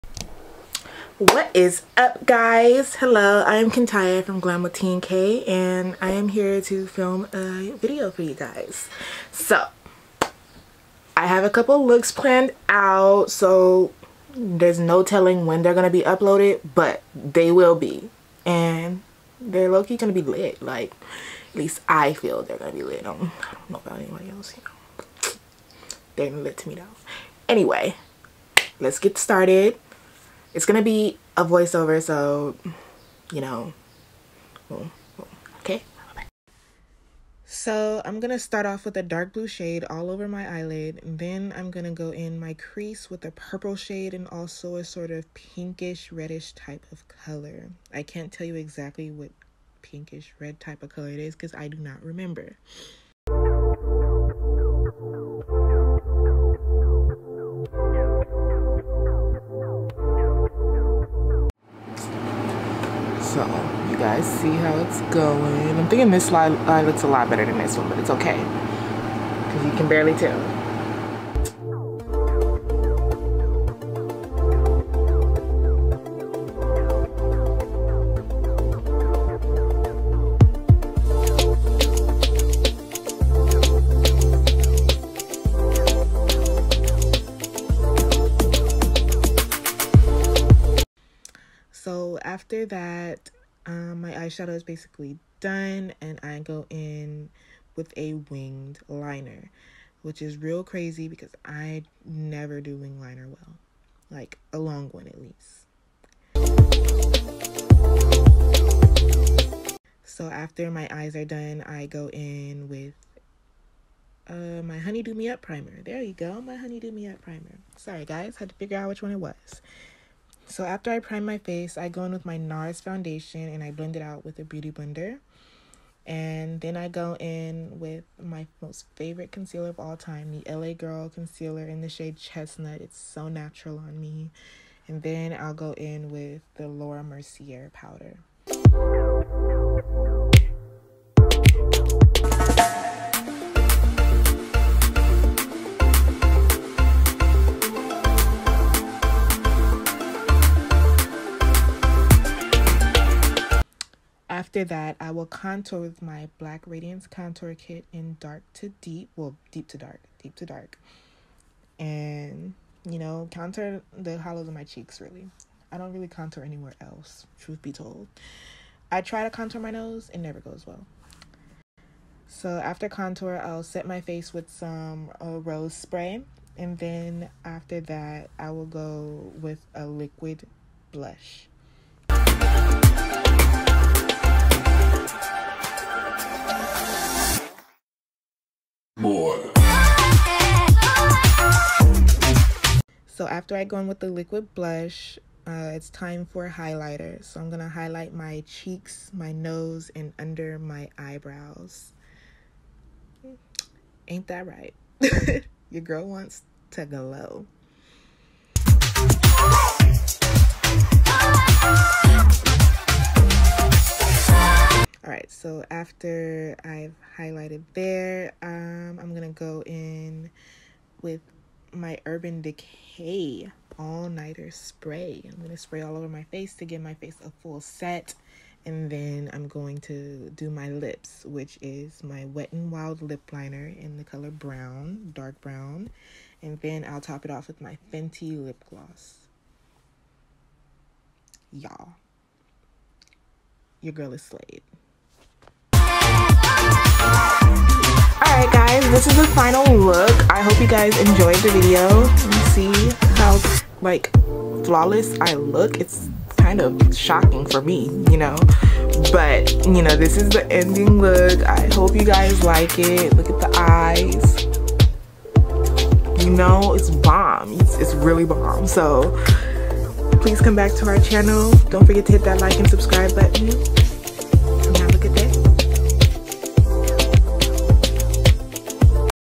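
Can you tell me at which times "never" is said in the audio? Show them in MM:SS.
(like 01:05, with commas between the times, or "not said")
01:42, 02:50.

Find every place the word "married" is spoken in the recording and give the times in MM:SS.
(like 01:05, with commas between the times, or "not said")
not said.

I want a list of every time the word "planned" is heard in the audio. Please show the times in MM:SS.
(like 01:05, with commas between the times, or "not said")
00:12.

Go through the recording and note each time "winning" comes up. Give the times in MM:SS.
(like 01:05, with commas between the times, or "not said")
not said.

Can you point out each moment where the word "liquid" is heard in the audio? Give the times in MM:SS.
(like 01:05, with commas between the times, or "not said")
02:59, 03:14.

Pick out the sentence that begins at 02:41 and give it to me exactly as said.
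And, you know, contour the hollows of my cheeks, really.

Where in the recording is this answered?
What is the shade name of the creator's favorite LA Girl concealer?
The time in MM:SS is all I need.
02:12.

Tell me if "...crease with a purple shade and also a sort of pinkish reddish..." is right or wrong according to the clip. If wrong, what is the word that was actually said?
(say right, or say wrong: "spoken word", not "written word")
right.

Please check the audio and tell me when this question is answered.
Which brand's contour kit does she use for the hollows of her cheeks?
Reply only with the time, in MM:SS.
02:36.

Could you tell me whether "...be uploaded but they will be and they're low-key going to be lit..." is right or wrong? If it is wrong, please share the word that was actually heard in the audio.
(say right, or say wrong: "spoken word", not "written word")
right.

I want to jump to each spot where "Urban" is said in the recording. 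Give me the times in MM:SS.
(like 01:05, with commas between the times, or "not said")
03:42.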